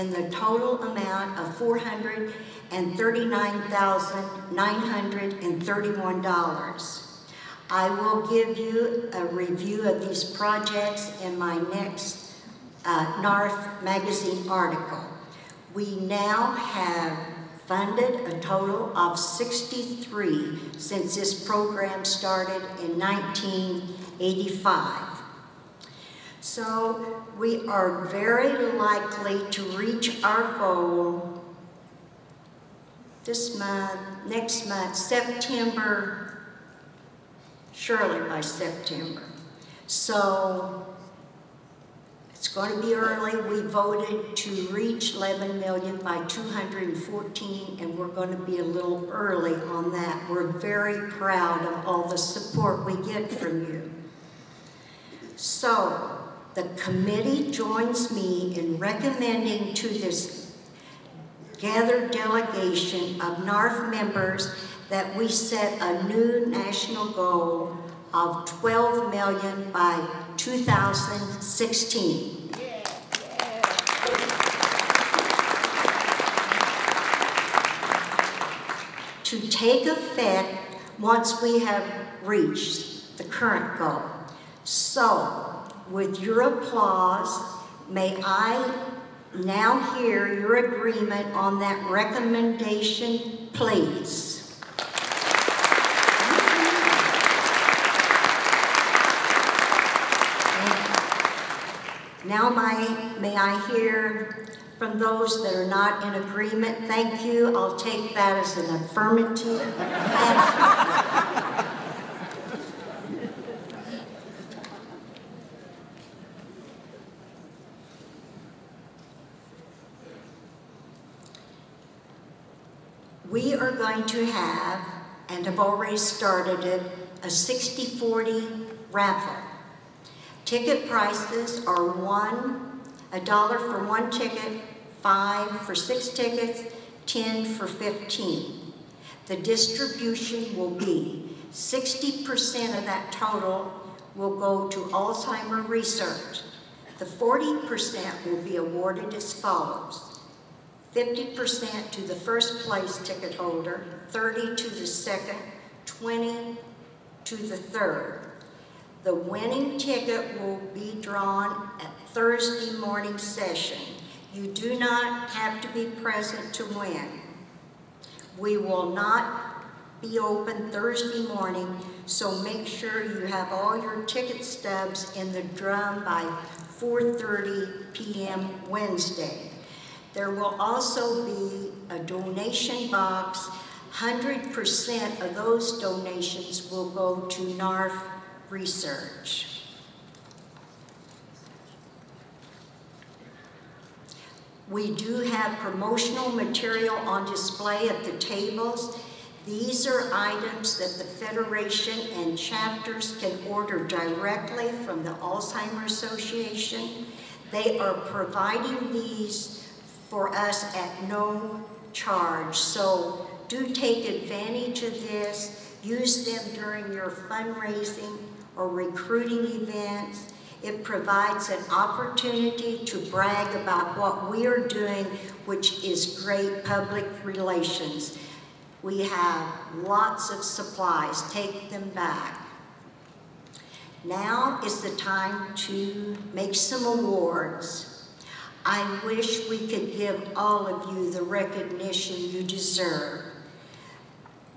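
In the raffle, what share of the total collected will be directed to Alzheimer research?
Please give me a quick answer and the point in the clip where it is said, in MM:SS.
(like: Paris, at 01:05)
60%, at 02:21.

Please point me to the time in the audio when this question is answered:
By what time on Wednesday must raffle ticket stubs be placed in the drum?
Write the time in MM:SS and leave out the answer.
02:56.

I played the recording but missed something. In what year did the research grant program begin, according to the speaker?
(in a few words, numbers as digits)
1985.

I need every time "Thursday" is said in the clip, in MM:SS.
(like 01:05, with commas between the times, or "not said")
02:42, 02:50.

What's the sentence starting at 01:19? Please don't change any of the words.
To take effect once we have reached the current goal.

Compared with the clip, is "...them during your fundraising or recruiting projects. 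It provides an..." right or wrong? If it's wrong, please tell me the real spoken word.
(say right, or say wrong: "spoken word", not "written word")
wrong: "events", not "projects".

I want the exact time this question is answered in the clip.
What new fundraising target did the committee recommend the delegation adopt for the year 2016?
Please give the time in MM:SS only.
01:08.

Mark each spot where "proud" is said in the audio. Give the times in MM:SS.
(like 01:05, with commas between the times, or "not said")
00:51.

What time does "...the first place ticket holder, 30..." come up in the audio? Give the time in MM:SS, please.
02:31.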